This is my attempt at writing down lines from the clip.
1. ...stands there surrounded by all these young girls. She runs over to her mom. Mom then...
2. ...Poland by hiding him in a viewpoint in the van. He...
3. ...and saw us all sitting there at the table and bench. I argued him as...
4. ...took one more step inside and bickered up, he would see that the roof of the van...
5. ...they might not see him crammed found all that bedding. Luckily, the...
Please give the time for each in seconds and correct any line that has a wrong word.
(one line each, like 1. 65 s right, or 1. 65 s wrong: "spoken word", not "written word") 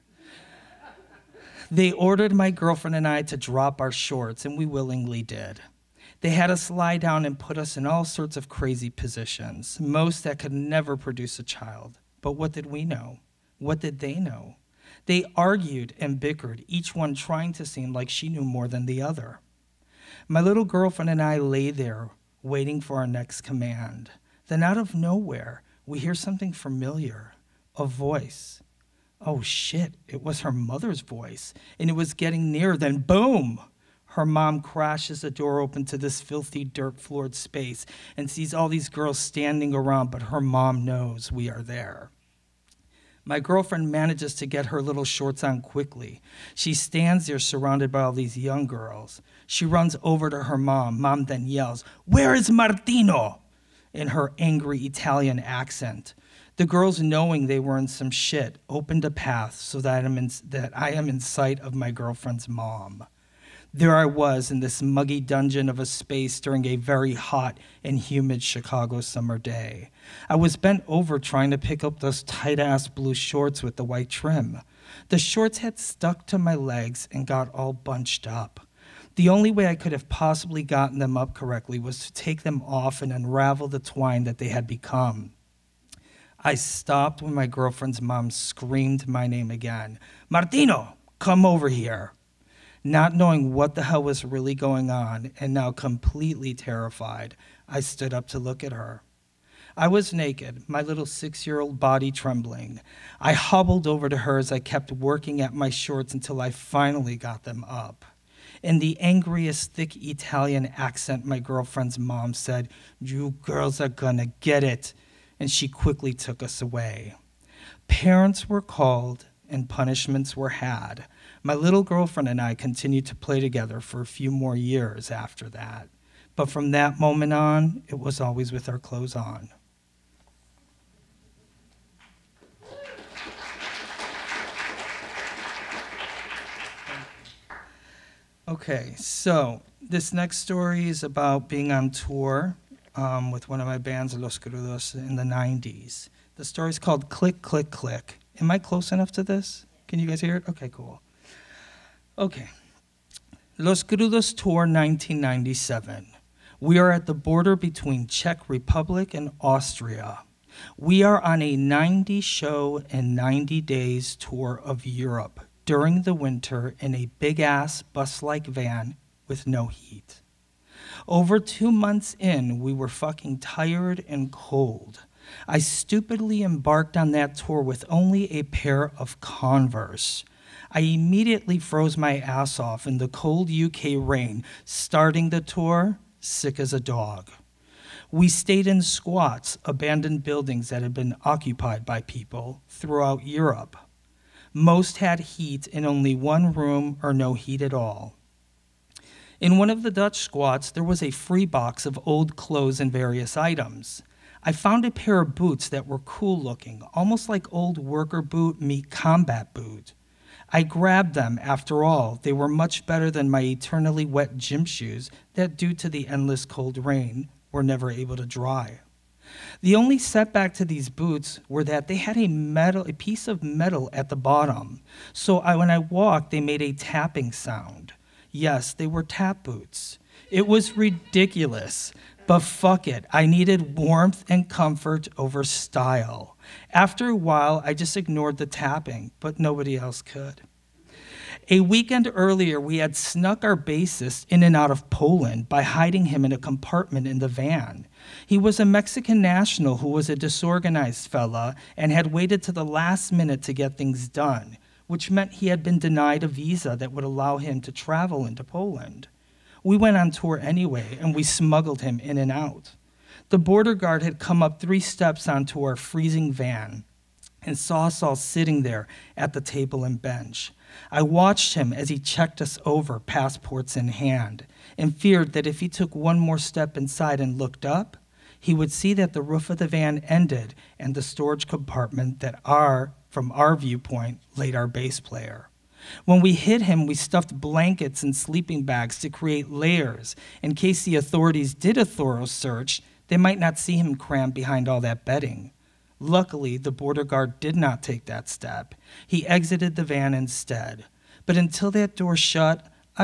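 1. 46 s right
2. 244 s wrong: "compartment", not "viewpoint"
3. 267 s wrong: "watched", not "argued"
4. 275 s wrong: "looked", not "bickered"
5. 293 s wrong: "behind", not "found".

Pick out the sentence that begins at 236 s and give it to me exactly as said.
After a while, I just ignored the tapping, but nobody else could.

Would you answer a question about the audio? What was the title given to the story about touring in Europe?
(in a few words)
Click, Click, Click.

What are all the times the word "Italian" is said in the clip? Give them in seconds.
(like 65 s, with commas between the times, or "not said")
54 s, 109 s.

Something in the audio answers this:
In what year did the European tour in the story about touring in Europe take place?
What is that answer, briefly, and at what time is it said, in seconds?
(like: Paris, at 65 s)
1997, at 154 s.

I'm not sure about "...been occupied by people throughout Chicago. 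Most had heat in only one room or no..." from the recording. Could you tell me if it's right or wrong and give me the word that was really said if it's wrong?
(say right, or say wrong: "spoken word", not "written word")
wrong: "Europe", not "Chicago".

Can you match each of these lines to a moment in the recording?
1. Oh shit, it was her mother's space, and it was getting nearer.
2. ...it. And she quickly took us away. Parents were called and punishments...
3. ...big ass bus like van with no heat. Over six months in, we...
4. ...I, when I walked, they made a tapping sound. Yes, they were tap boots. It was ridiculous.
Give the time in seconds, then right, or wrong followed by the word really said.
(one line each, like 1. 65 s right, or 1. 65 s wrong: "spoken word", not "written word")
1. 29 s wrong: "voice", not "space"
2. 114 s right
3. 167 s wrong: "two", not "six"
4. 225 s right.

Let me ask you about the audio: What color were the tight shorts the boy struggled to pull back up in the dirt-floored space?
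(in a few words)
blue.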